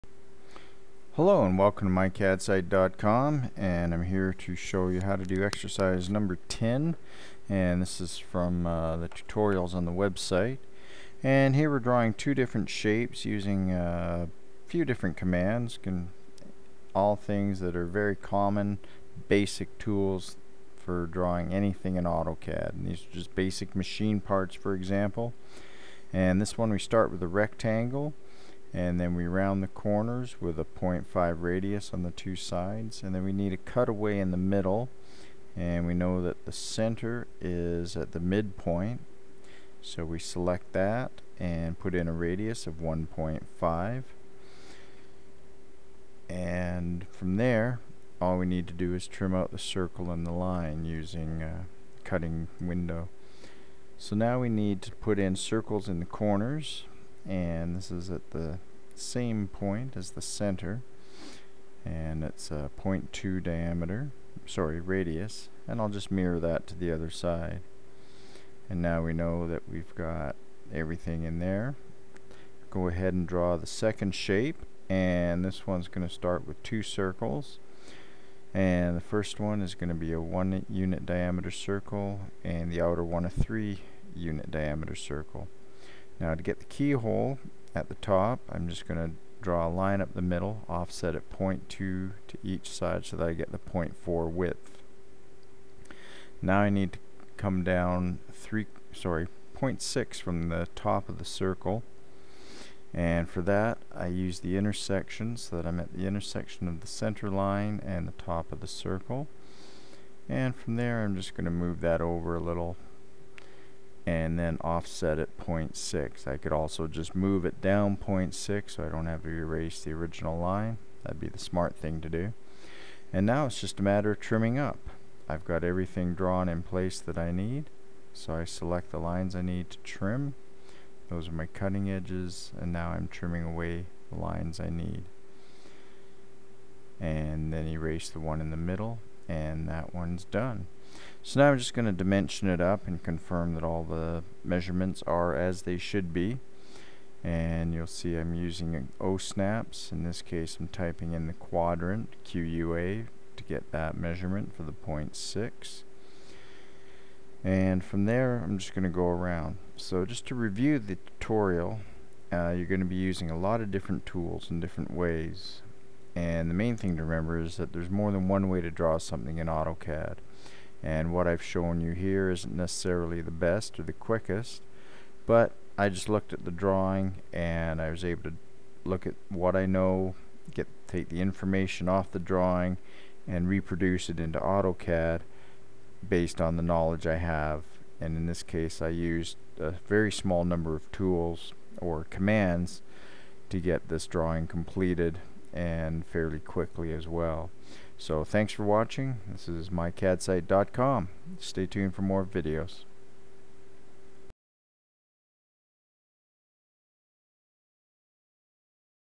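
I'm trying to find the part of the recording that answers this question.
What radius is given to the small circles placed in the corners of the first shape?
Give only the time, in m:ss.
1:02.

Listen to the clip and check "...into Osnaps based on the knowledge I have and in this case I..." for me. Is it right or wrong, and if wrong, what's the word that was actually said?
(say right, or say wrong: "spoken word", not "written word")
wrong: "AutoCAD", not "Osnaps".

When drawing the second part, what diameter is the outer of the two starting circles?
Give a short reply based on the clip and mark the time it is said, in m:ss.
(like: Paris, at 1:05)
3, at 1:23.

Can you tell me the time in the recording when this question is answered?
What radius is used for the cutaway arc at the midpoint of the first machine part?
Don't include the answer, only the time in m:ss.
0:42.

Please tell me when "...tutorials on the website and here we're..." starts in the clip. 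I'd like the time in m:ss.
0:09.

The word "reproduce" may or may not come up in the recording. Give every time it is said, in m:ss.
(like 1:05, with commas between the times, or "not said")
3:03.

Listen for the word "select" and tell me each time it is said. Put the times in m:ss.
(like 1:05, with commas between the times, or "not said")
0:40, 2:08.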